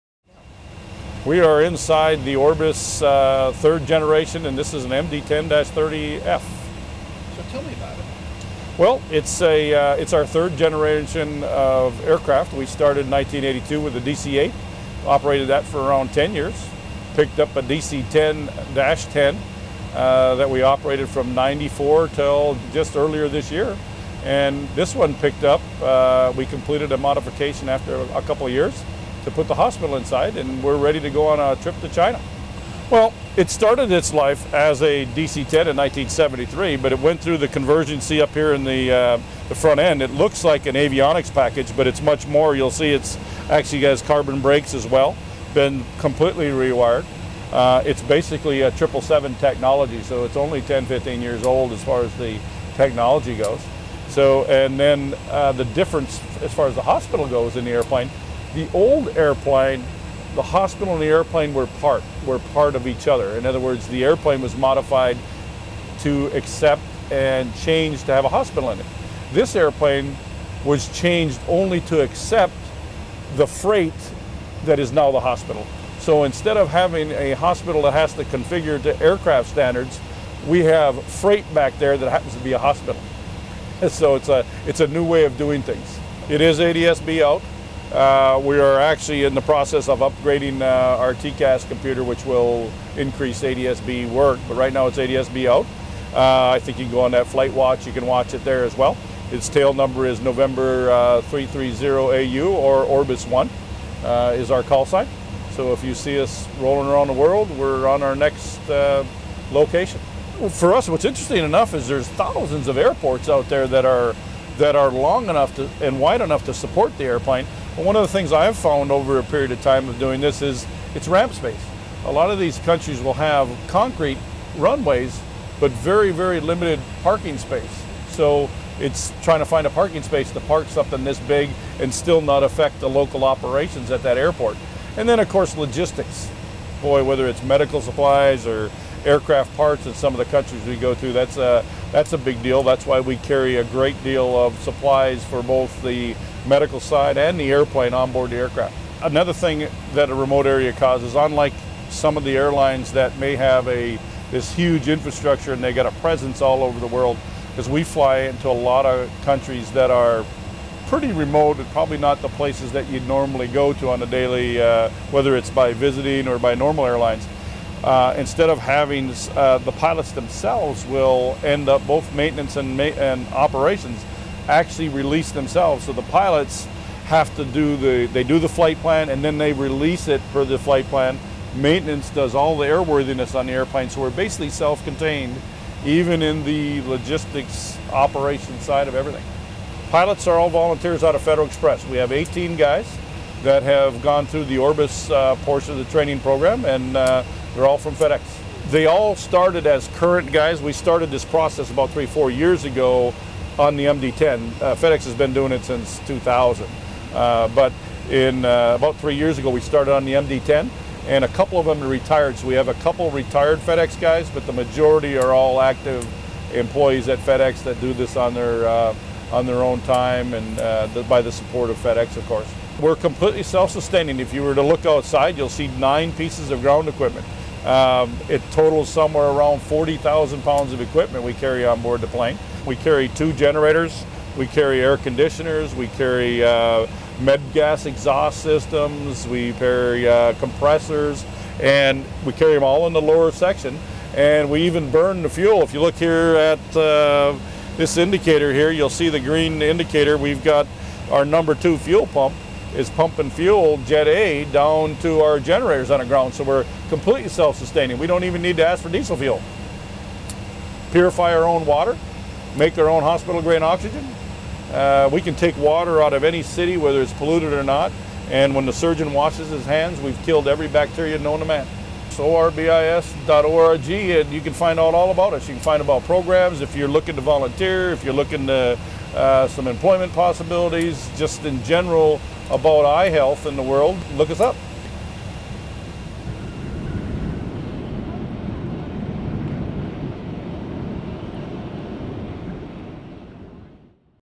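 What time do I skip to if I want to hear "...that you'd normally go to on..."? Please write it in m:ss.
2:42.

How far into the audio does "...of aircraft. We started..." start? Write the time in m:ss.
0:11.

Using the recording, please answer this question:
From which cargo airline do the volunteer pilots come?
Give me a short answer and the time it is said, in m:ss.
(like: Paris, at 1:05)
Federal Express, at 3:11.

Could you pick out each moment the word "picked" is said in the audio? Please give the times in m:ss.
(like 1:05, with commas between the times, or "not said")
0:17, 0:25.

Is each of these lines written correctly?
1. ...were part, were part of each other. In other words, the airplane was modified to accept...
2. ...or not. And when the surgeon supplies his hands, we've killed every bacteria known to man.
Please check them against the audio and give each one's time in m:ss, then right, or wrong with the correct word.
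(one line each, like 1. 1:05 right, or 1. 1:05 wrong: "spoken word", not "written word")
1. 1:01 right
2. 4:27 wrong: "washes", not "supplies".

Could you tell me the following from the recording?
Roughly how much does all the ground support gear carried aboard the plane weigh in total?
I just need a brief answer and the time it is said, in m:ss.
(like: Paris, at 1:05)
40,000 pounds, at 3:49.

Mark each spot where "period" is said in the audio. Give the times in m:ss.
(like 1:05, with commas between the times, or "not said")
1:59.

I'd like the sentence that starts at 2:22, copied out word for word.
That's why we carry a great deal of supplies for both the medical side and the airplane on board the aircraft.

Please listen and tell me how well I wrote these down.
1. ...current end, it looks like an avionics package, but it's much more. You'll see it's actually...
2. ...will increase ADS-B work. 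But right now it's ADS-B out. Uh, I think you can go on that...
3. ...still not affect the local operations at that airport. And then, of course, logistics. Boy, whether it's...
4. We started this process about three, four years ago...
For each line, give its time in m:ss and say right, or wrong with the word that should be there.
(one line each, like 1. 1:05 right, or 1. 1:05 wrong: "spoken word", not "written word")
1. 0:39 wrong: "front", not "current"
2. 1:32 right
3. 2:11 right
4. 3:20 right.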